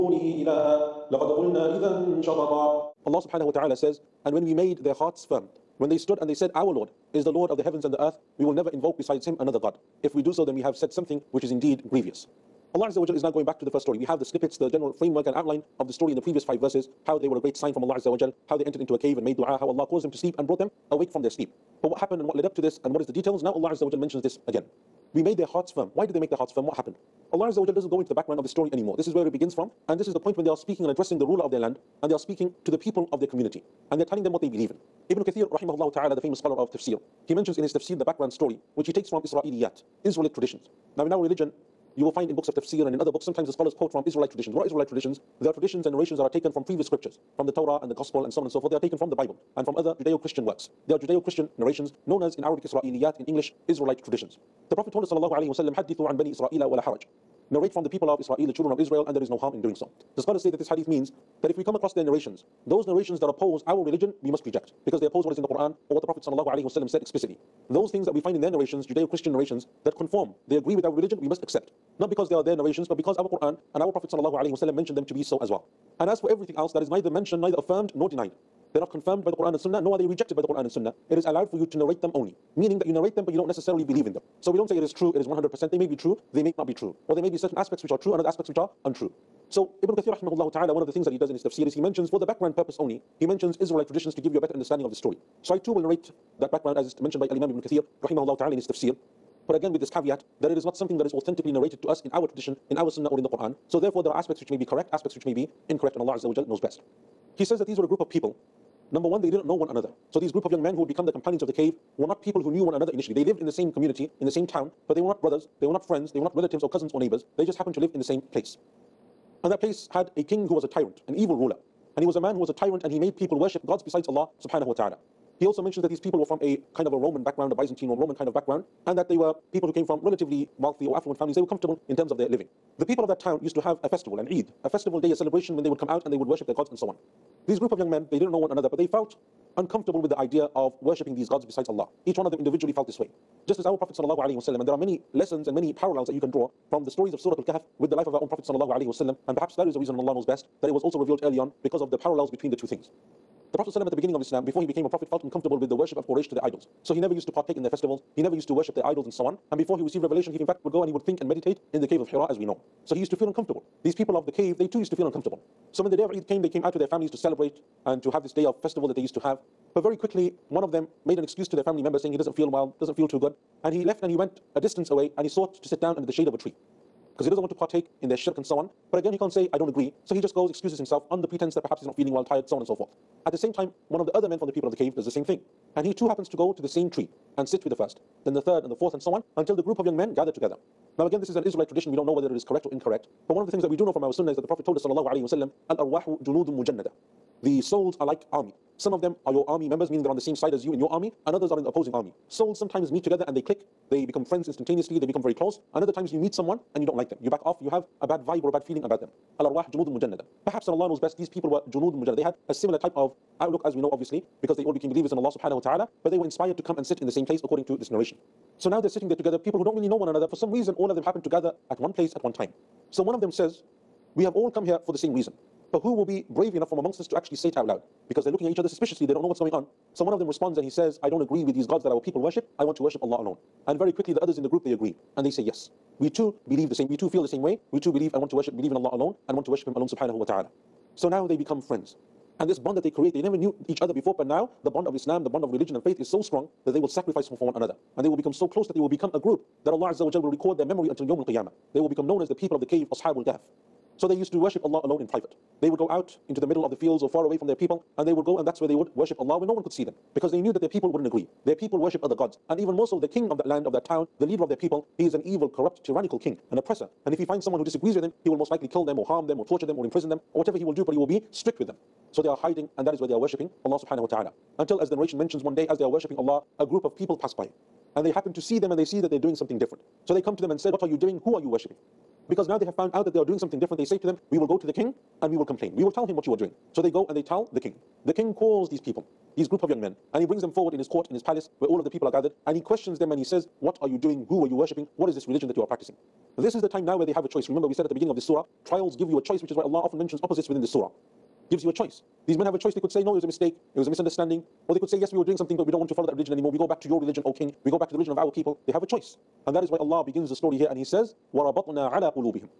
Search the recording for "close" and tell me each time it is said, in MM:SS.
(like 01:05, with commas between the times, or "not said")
03:25, 04:08.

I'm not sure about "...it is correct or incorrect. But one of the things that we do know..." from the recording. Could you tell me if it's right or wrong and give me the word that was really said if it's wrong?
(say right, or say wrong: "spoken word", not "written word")
right.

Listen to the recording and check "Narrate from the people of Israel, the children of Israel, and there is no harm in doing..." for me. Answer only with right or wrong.
right.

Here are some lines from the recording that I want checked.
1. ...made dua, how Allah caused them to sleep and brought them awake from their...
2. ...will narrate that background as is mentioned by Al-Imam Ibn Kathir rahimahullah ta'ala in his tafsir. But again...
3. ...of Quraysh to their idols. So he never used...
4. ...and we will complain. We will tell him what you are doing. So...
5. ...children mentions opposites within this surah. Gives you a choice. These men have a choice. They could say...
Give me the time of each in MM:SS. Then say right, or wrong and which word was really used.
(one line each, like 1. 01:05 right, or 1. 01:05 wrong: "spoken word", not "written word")
1. 00:19 right
2. 01:35 right
3. 02:35 right
4. 04:45 right
5. 04:59 wrong: "often", not "children".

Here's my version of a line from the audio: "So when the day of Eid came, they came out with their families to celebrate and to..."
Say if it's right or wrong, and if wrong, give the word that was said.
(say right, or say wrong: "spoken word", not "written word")
right.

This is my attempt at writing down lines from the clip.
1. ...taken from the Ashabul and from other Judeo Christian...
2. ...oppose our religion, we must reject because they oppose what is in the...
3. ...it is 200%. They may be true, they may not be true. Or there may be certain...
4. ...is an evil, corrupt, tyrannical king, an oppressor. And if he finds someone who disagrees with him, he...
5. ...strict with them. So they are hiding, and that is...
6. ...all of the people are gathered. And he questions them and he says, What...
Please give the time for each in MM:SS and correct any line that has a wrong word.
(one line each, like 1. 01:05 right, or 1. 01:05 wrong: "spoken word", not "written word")
1. 00:48 wrong: "Bible", not "Ashabul"
2. 01:03 right
3. 01:25 wrong: "100", not "200"
4. 04:25 right
5. 04:31 right
6. 04:51 right.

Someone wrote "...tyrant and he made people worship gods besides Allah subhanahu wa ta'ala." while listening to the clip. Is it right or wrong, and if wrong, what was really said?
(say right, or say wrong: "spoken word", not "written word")
right.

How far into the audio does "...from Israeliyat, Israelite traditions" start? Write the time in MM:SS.
00:39.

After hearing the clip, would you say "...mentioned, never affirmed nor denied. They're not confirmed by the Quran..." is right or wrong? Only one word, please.
wrong.